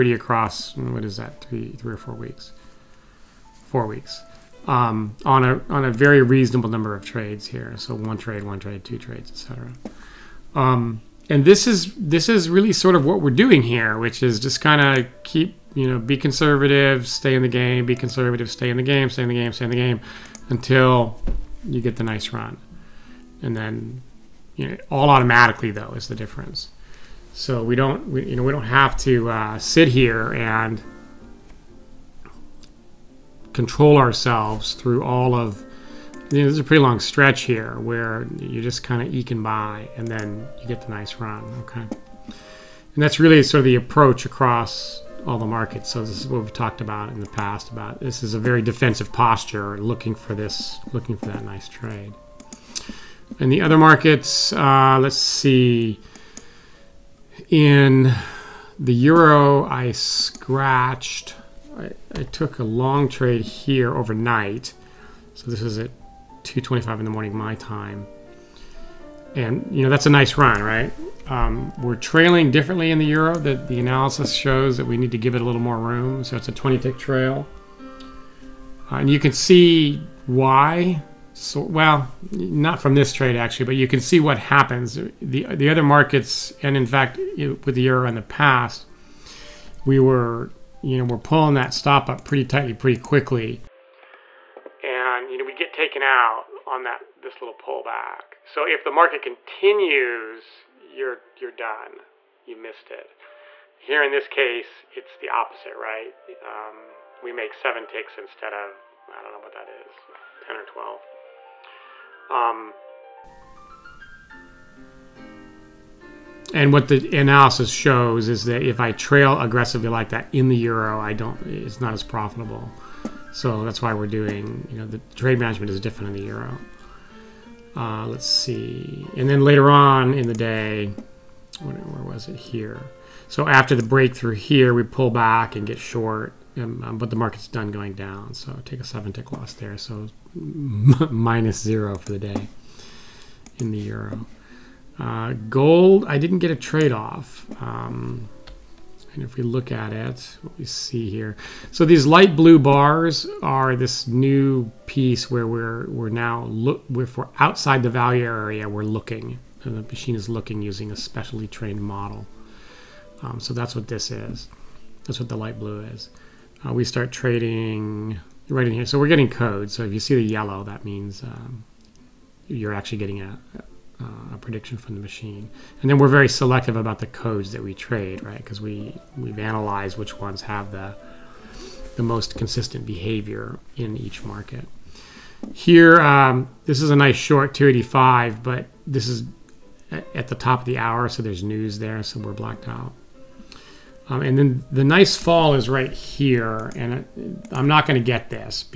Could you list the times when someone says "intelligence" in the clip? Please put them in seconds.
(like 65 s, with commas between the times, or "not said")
not said.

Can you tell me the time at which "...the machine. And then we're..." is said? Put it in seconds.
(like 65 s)
174 s.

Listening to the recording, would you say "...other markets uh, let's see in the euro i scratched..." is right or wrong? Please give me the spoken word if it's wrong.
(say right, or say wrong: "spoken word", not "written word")
right.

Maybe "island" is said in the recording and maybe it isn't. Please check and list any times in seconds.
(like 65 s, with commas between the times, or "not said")
not said.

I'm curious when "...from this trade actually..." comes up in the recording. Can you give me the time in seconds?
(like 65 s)
82 s.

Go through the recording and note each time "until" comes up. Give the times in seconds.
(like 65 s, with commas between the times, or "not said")
20 s.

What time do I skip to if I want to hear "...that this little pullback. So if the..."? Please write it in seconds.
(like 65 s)
96 s.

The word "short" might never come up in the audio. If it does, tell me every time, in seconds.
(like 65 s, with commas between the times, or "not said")
135 s, 187 s.